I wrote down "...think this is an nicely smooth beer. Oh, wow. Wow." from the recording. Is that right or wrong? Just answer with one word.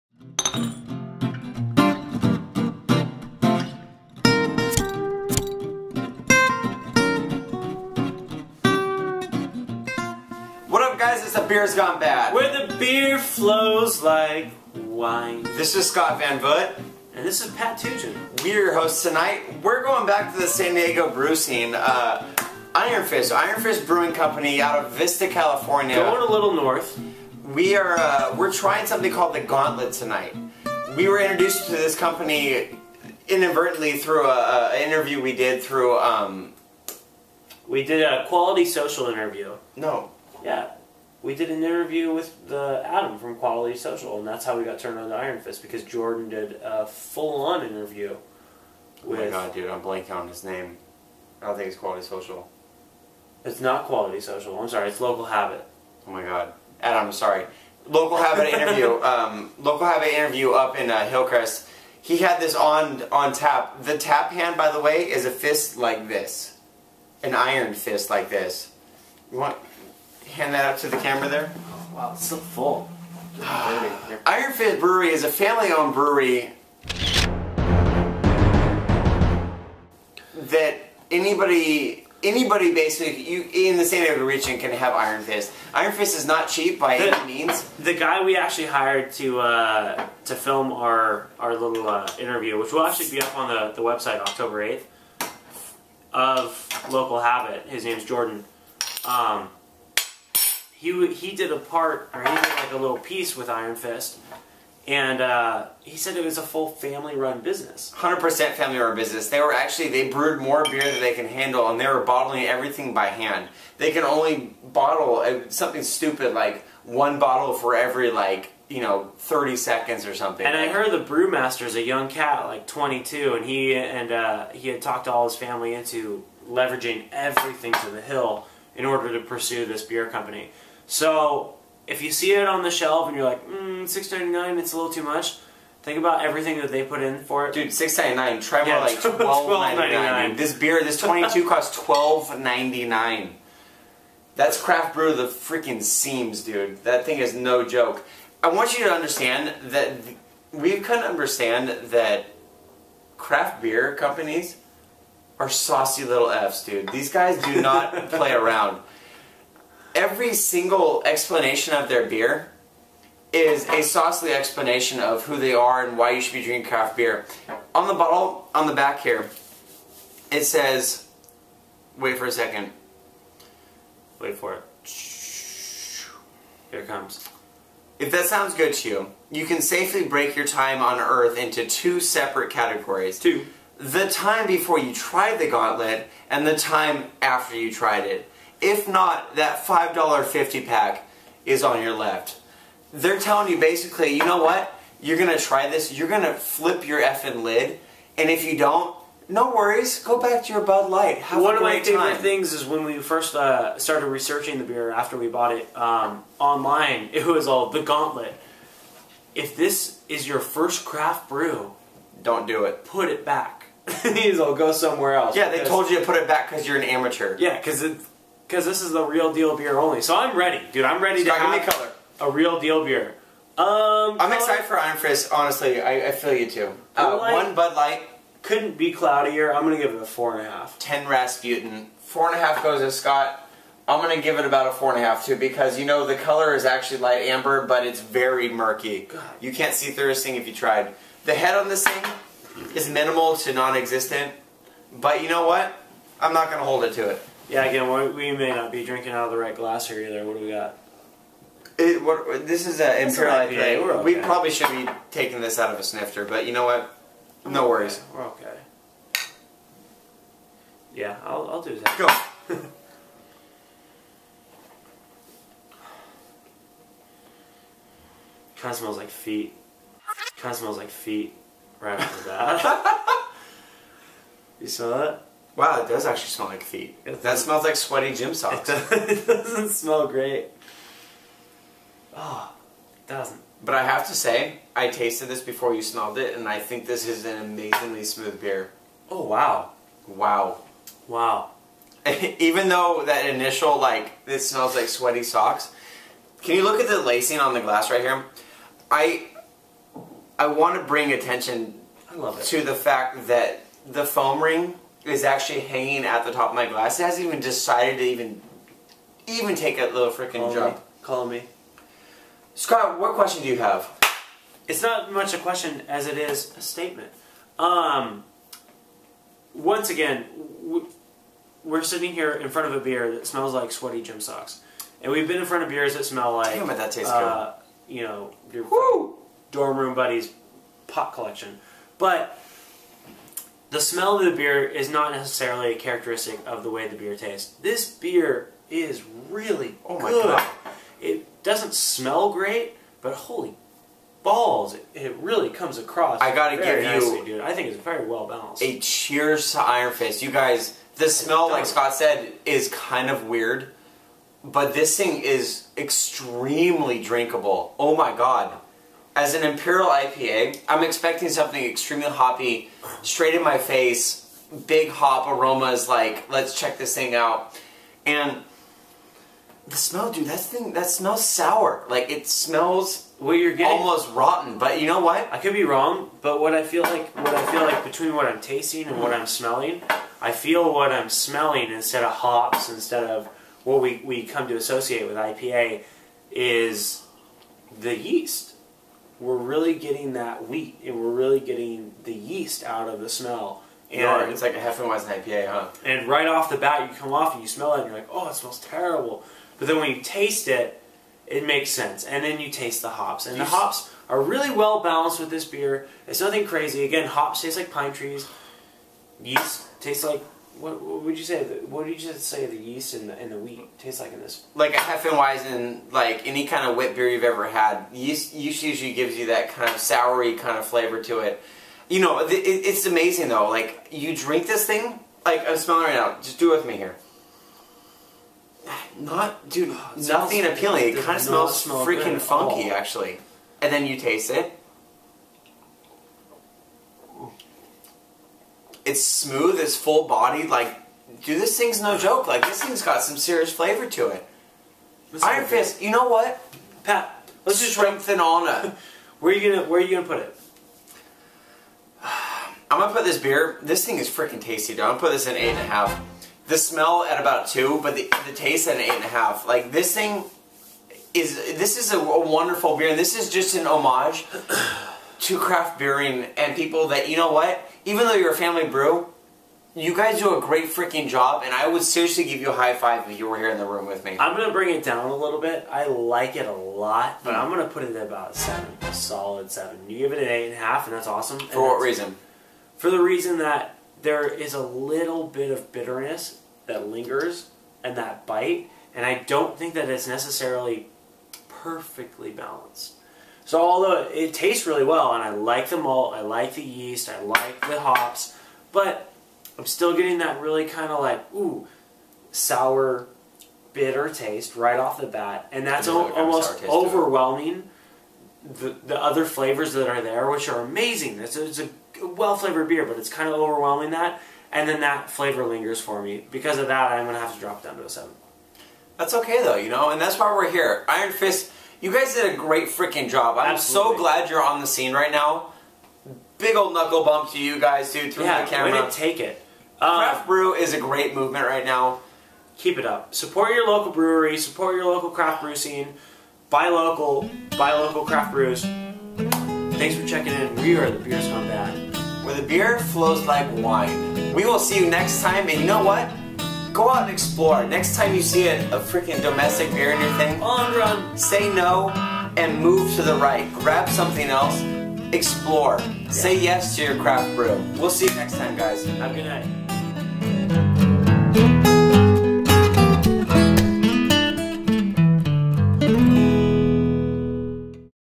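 wrong.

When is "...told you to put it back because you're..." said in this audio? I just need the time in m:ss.
3:35.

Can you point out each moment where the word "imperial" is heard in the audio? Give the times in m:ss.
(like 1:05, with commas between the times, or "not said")
4:13, 5:59.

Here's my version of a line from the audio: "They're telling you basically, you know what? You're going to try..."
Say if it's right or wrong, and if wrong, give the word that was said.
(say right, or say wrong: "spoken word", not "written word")
right.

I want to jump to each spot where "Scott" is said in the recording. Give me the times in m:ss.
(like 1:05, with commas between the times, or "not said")
0:15, 3:52, 5:12, 5:51.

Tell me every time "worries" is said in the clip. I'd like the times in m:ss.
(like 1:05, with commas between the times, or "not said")
3:19, 4:17.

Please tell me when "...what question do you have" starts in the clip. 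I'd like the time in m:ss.
5:12.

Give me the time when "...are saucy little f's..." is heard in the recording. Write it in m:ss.
2:35.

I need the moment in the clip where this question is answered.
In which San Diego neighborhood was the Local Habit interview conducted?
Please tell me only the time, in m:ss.
1:01.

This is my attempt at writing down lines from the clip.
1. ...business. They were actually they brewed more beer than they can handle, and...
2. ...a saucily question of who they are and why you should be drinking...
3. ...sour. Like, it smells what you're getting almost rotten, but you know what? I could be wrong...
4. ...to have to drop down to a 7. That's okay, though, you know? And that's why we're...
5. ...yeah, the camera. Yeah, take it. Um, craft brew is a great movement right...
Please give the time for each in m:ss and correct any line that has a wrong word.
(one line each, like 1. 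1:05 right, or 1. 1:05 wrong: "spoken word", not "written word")
1. 1:48 right
2. 2:43 wrong: "explanation", not "question"
3. 6:11 right
4. 8:37 right
5. 8:48 right.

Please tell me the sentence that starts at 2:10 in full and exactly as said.
So if you see it on the shelf and you're like, mm, six ninety nine, it's a little too much.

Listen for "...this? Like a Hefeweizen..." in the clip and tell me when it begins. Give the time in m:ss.
6:54.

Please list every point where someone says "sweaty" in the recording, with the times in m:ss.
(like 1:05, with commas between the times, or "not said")
4:37, 4:54, 5:23.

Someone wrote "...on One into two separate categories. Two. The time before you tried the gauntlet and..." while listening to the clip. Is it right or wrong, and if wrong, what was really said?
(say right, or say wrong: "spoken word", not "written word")
wrong: "Earth", not "One".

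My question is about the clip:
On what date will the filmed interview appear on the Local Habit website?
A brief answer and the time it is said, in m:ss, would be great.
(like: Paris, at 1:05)
October 8, at 1:34.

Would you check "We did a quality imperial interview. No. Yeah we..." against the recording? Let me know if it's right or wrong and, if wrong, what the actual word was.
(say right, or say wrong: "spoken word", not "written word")
wrong: "social", not "imperial".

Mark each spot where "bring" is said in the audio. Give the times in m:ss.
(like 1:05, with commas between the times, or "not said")
5:00, 7:54.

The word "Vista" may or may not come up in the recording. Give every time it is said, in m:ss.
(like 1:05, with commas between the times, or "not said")
0:24.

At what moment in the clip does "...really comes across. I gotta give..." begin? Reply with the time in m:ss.
5:45.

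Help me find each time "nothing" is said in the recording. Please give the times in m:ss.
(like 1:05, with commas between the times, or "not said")
6:46, 7:09.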